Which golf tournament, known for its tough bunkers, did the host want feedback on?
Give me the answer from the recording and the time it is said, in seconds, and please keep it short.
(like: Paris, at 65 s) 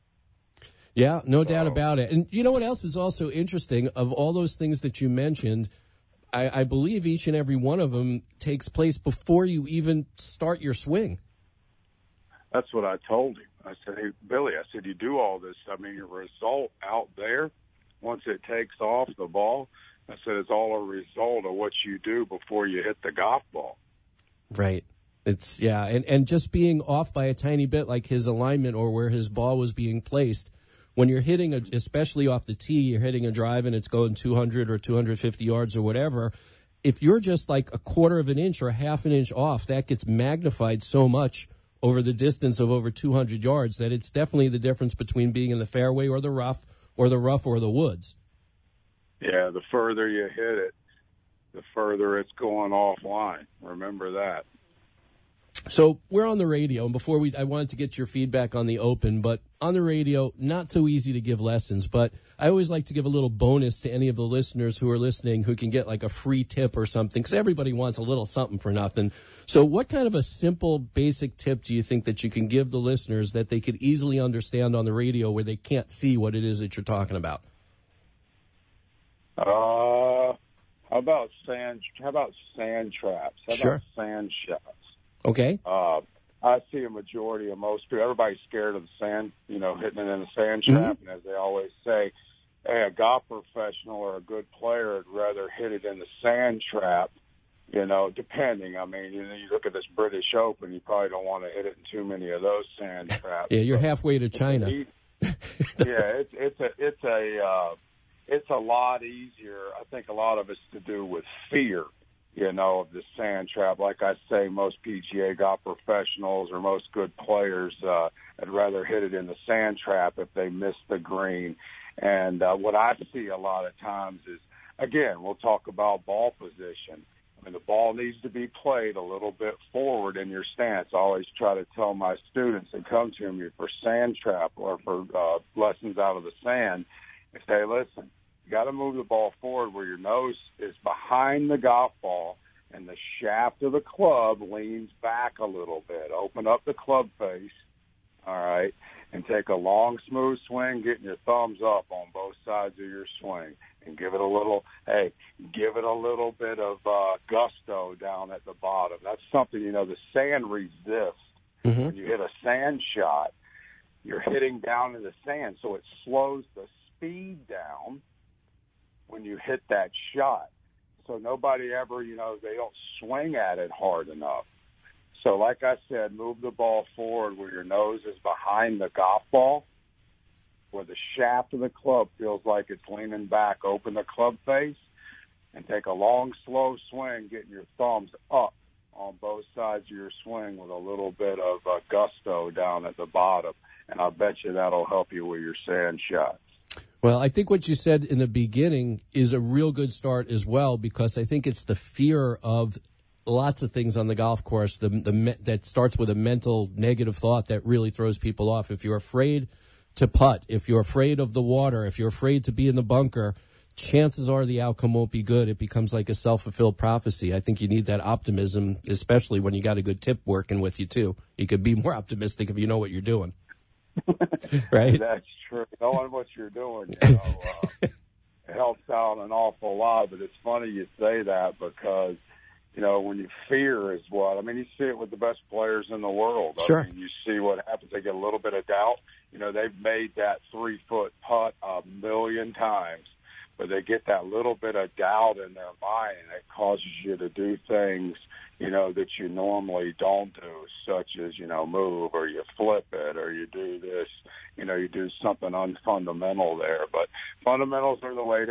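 British Open, at 99 s.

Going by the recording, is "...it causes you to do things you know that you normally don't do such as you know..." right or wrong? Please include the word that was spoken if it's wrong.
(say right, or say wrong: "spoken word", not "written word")
right.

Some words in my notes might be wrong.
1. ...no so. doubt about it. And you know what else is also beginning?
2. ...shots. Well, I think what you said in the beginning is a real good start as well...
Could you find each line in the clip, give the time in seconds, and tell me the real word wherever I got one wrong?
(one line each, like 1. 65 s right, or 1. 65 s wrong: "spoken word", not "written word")
1. 1 s wrong: "interesting", not "beginning"
2. 196 s right.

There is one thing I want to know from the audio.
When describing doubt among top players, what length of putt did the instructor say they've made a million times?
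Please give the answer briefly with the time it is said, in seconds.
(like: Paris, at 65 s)
3 foot, at 240 s.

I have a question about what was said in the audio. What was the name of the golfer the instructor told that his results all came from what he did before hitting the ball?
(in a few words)
Billy.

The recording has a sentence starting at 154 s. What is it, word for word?
Hey, give it a little bit of uh, gusto down at the bottom.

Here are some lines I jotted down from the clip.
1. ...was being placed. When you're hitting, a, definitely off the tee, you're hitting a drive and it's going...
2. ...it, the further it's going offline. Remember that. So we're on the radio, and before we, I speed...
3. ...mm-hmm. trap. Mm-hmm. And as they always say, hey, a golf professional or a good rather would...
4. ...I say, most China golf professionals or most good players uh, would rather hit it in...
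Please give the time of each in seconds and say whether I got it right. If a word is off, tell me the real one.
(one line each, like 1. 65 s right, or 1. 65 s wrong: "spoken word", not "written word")
1. 29 s wrong: "especially", not "definitely"
2. 50 s wrong: "wanted", not "speed"
3. 90 s wrong: "player", not "rather"
4. 114 s wrong: "PGA", not "China".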